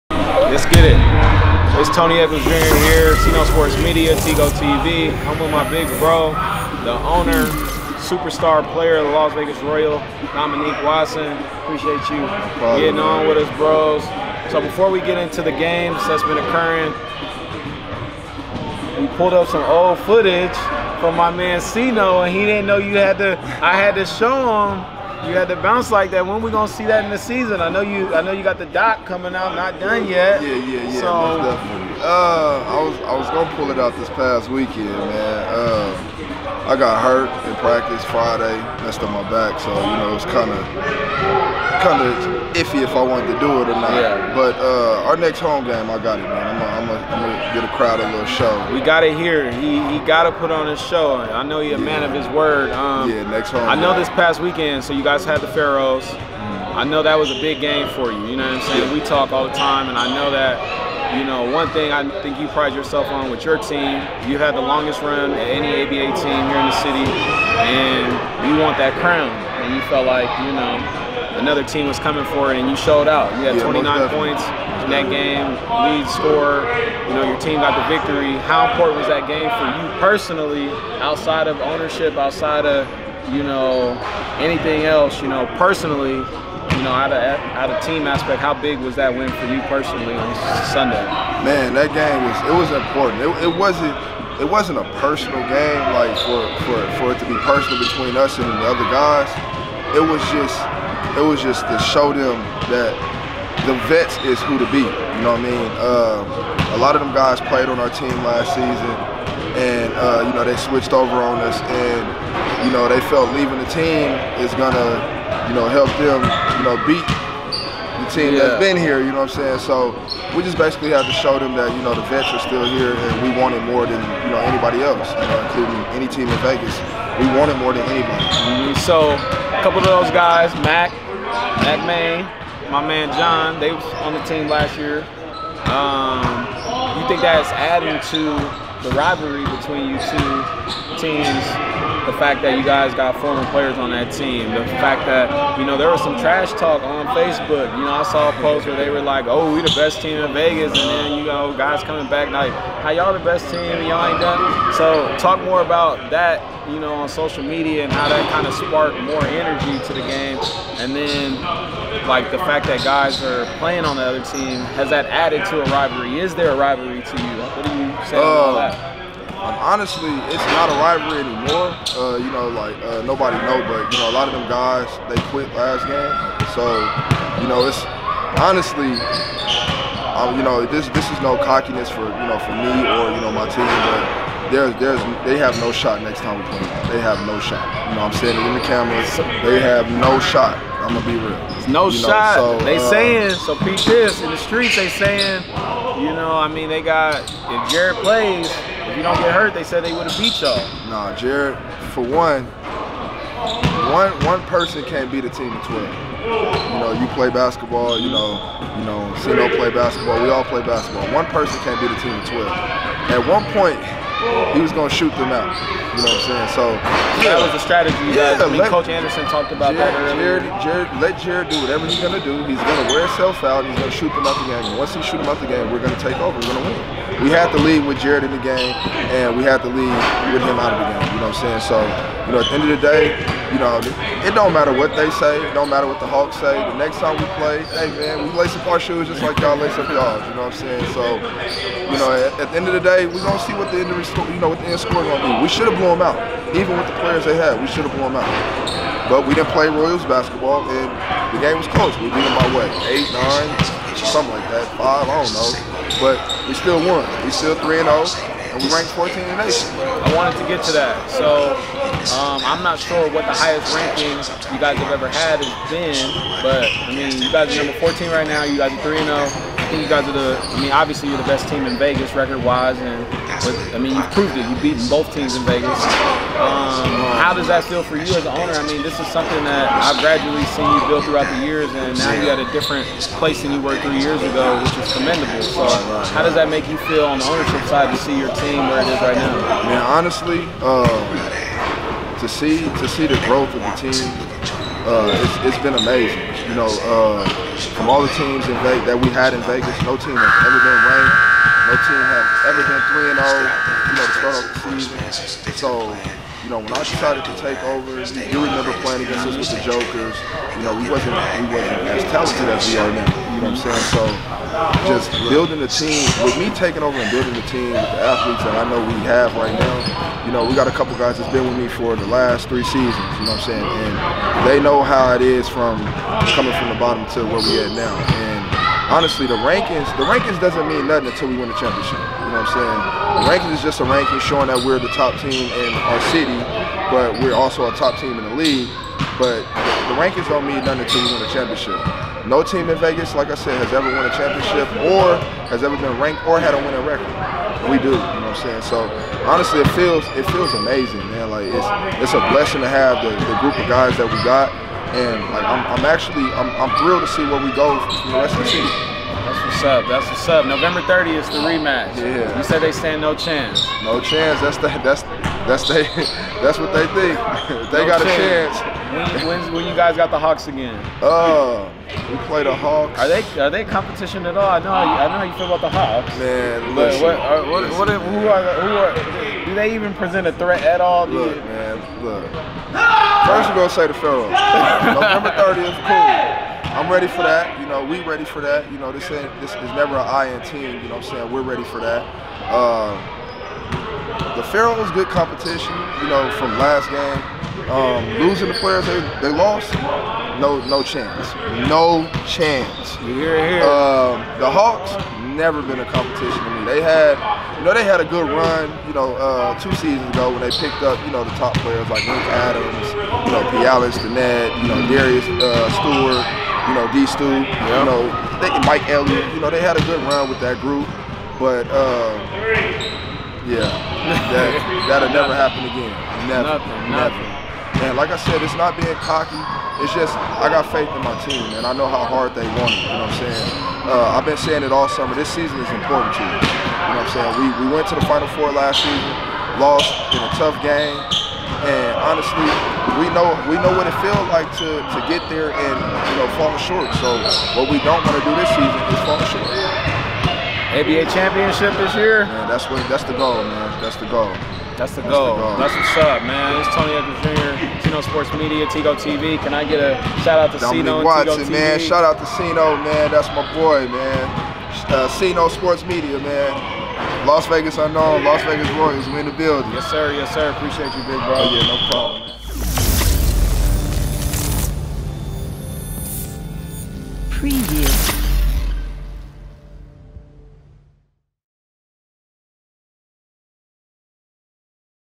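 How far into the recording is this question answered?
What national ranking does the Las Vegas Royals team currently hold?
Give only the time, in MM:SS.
04:18.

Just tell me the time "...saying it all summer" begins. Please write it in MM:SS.
07:14.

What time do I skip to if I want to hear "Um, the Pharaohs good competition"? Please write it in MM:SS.
06:32.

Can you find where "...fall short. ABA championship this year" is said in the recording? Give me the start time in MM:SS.
07:29.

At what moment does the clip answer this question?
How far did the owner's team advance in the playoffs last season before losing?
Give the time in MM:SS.
07:18.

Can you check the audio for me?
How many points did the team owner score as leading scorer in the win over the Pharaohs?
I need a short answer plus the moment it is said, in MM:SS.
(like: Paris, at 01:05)
29, at 01:13.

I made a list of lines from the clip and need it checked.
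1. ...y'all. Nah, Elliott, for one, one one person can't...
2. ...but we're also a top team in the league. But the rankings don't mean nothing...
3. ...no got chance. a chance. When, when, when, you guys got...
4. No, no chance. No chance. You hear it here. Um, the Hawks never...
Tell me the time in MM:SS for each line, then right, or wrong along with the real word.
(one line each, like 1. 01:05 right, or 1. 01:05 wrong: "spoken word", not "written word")
1. 03:20 wrong: "Jared", not "Elliott"
2. 05:36 right
3. 06:07 right
4. 06:40 right.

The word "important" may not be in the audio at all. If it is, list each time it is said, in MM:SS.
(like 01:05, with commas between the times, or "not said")
01:18, 01:32, 07:15.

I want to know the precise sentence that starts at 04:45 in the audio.
So, how does that make you feel on the ownership side to see your team where it is right now?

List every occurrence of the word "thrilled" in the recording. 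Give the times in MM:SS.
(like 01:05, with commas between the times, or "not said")
05:56.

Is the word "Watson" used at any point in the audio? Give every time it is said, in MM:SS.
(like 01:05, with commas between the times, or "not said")
00:10, 07:41.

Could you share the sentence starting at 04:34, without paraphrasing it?
You've beaten both teams in Vegas.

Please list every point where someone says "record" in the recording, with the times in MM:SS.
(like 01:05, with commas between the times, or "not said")
04:32, 05:46.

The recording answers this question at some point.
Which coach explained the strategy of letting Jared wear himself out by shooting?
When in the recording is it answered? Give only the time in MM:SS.
03:38.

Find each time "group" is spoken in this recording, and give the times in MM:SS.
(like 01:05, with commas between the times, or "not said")
05:53, 07:00.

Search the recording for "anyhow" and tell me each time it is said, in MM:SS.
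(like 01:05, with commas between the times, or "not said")
not said.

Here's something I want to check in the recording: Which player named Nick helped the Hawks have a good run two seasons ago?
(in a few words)
Nick Adams.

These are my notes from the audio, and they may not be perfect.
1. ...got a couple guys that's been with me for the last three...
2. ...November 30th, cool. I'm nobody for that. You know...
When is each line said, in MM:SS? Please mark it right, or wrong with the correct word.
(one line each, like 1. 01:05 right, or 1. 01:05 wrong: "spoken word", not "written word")
1. 05:20 right
2. 06:24 wrong: "ready", not "nobody".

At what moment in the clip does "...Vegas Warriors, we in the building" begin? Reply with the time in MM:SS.
07:48.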